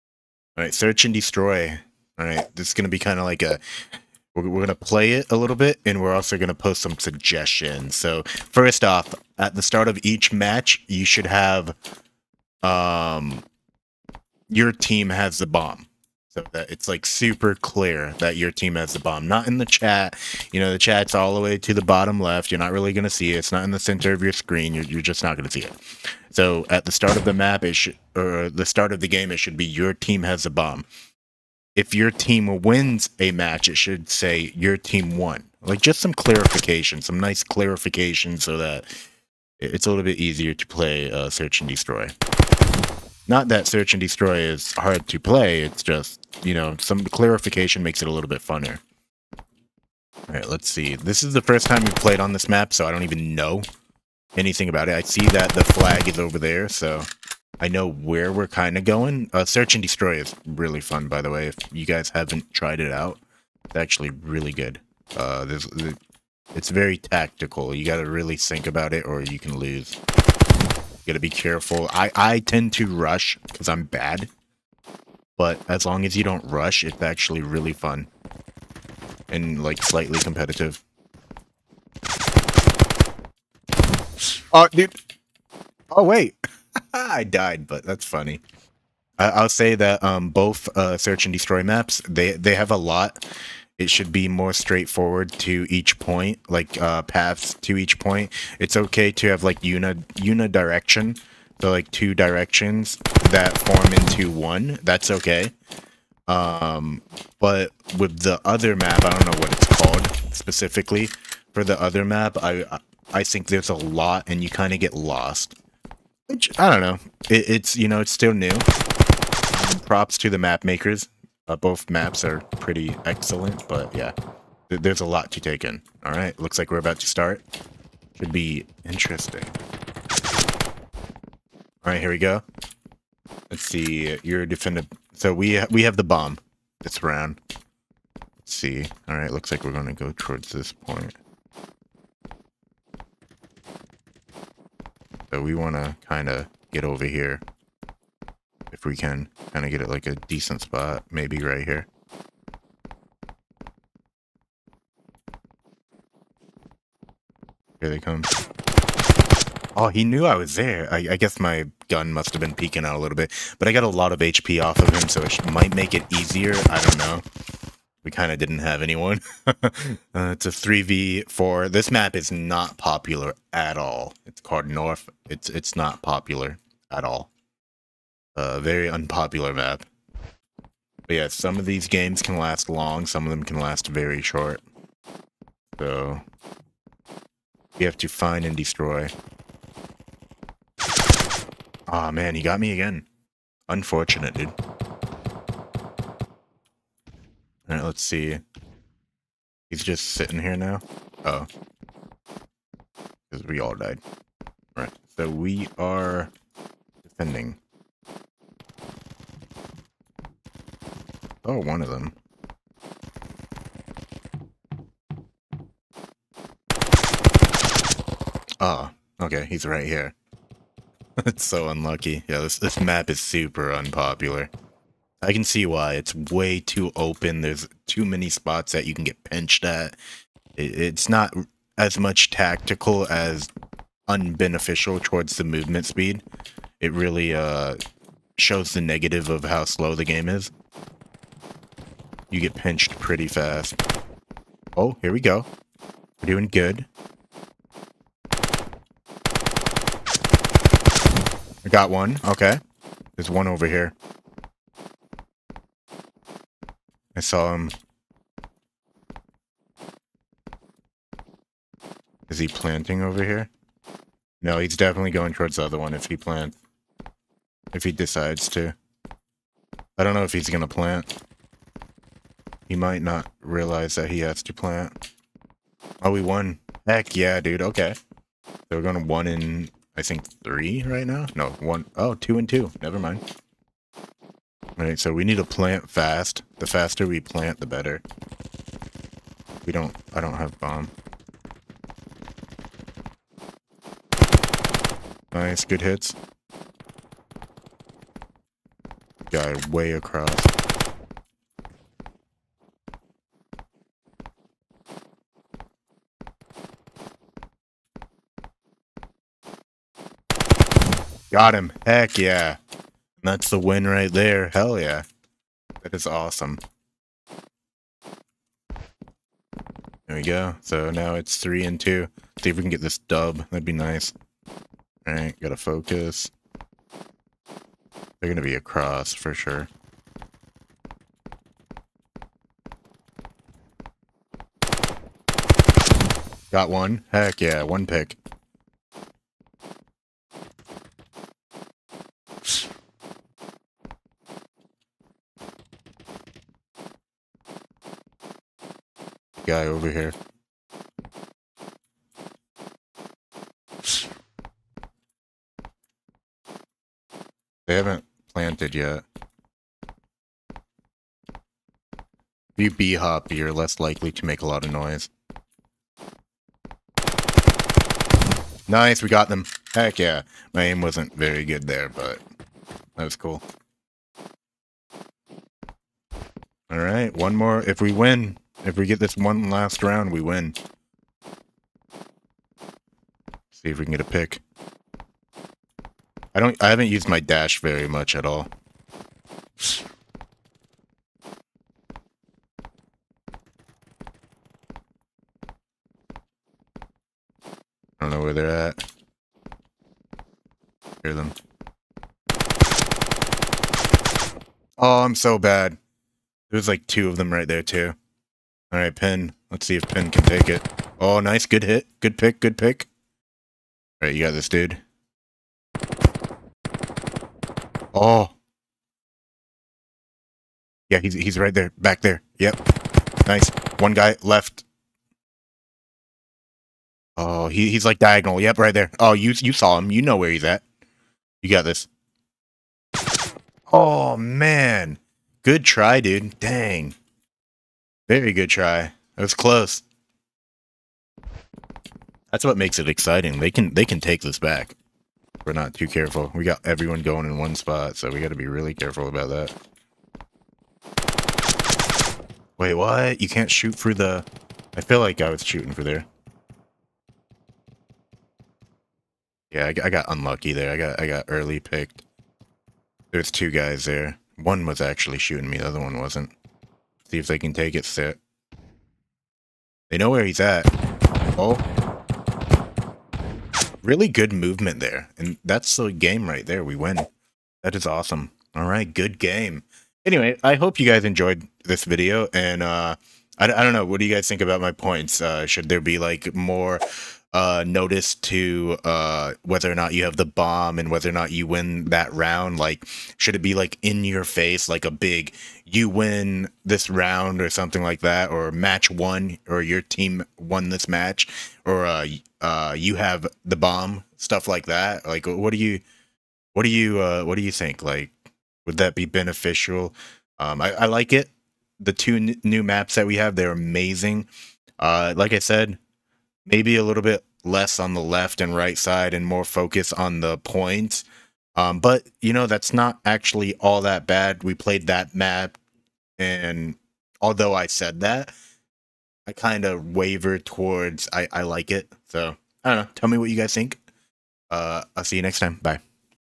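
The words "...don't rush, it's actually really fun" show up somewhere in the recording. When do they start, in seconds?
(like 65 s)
76 s.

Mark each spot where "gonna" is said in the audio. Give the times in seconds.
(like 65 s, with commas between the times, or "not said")
139 s, 328 s.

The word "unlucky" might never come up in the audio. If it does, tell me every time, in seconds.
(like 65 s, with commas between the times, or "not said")
221 s, 460 s.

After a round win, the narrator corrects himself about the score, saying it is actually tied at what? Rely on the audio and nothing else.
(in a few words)
2 and 2.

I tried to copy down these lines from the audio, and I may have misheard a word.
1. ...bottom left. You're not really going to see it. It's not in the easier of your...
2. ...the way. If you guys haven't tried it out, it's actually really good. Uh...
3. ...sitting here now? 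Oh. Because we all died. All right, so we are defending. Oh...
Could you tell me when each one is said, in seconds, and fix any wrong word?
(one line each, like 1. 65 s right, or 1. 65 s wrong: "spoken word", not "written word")
1. 21 s wrong: "center", not "easier"
2. 61 s right
3. 200 s right.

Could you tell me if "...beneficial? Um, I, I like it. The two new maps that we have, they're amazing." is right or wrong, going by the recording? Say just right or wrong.
right.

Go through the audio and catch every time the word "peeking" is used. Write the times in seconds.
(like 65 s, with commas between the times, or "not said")
162 s.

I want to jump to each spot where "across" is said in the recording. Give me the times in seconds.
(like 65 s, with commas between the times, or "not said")
299 s, 328 s.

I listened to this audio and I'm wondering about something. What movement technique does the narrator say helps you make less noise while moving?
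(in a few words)
B-hop.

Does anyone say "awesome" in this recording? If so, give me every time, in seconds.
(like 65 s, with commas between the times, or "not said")
316 s, 477 s.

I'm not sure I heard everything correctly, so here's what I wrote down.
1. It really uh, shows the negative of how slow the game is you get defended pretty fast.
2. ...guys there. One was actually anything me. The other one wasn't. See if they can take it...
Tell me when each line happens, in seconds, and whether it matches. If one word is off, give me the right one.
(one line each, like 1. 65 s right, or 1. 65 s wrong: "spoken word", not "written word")
1. 236 s wrong: "pinched", not "defended"
2. 463 s wrong: "shooting", not "anything".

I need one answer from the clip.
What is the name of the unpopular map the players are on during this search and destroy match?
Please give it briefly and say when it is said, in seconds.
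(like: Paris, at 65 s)
North, at 174 s.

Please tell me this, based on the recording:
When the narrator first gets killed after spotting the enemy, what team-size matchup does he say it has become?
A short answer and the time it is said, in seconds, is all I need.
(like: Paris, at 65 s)
3v4, at 170 s.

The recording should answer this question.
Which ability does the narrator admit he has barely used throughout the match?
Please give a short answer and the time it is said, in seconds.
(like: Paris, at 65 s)
Dash, at 387 s.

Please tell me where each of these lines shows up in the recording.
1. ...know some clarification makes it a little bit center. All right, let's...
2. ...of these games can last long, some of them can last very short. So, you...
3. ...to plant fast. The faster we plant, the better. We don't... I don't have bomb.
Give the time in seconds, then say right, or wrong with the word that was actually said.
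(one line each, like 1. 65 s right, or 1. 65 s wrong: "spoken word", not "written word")
1. 46 s wrong: "funner", not "center"
2. 181 s right
3. 285 s right.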